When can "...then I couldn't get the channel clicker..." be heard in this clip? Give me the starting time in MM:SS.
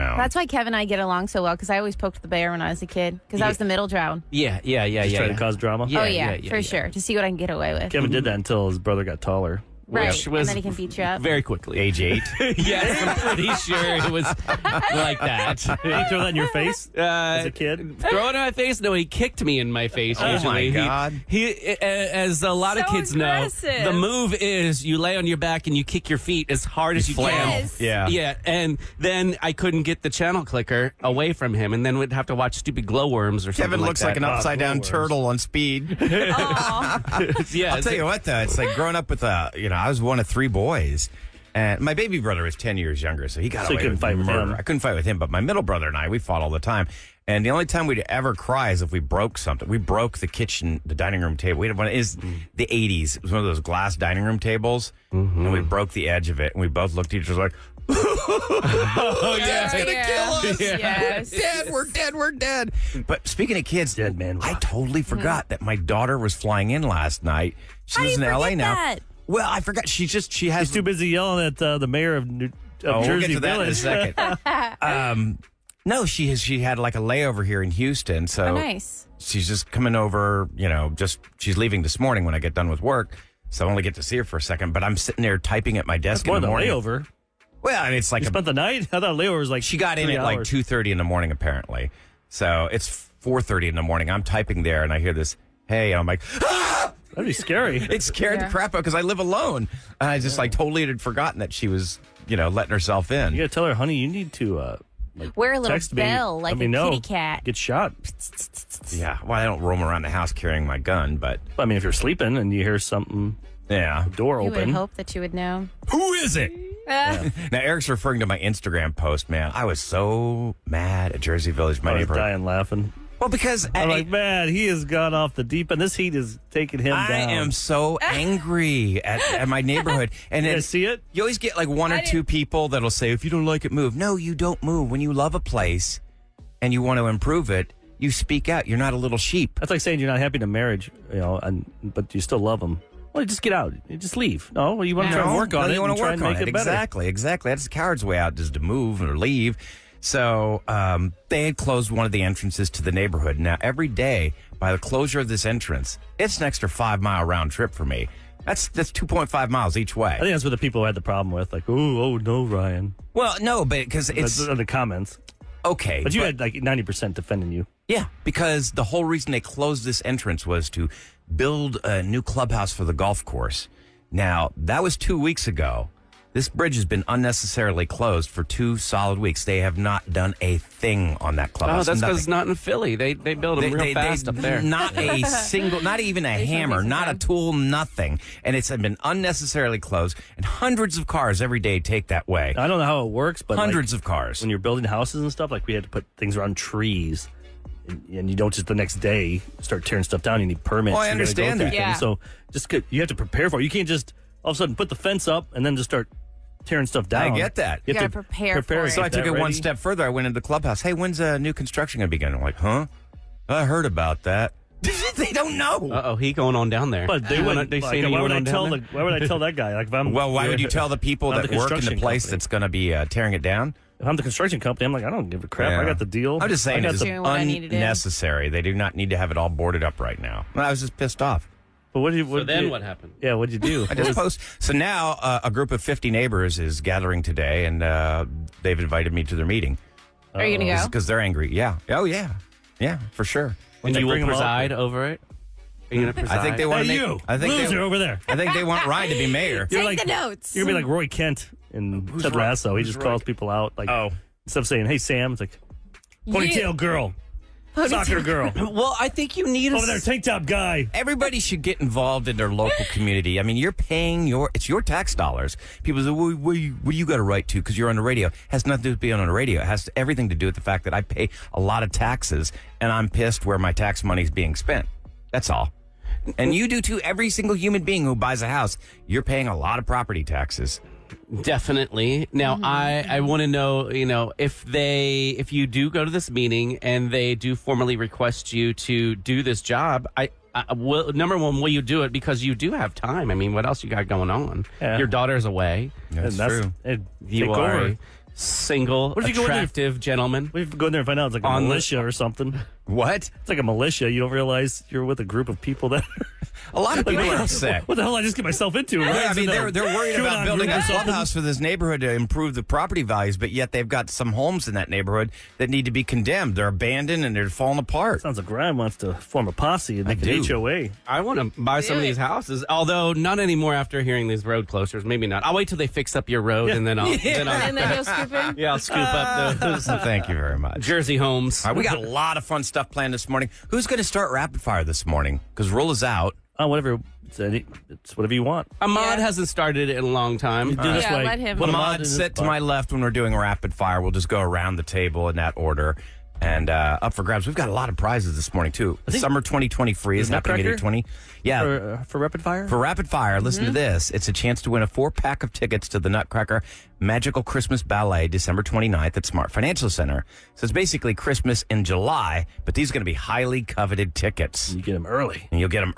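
00:28.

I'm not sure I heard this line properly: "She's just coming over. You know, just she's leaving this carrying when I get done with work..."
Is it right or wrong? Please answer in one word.
wrong.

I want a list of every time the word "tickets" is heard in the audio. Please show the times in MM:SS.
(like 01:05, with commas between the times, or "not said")
05:55, 06:04.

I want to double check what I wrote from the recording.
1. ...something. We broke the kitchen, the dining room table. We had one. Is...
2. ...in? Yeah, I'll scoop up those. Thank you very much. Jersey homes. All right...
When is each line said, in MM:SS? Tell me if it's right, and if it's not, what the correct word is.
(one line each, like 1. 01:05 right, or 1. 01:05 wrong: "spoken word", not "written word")
1. 00:49 right
2. 05:28 right.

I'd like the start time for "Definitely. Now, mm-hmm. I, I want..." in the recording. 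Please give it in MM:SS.
04:41.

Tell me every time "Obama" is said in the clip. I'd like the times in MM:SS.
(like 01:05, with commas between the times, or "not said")
not said.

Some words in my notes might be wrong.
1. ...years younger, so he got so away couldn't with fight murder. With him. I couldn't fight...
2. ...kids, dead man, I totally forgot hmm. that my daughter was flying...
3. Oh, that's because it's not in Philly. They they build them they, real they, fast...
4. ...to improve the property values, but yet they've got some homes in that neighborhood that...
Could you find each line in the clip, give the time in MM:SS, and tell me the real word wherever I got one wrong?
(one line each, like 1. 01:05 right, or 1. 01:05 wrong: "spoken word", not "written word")
1. 00:42 right
2. 01:03 right
3. 03:01 right
4. 05:12 right.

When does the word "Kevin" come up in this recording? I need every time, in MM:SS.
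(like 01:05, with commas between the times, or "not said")
00:00, 00:07, 00:33.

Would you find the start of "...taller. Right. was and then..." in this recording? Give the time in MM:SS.
00:09.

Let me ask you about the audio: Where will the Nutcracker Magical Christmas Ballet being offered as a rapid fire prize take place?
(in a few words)
Smart Financial Center.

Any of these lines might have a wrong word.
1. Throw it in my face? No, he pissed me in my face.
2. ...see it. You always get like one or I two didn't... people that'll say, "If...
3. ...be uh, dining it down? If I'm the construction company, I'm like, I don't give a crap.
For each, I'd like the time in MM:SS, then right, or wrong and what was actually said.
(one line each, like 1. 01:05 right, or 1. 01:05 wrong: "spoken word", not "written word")
1. 00:17 wrong: "kicked", not "pissed"
2. 02:10 right
3. 03:42 wrong: "tearing", not "dining".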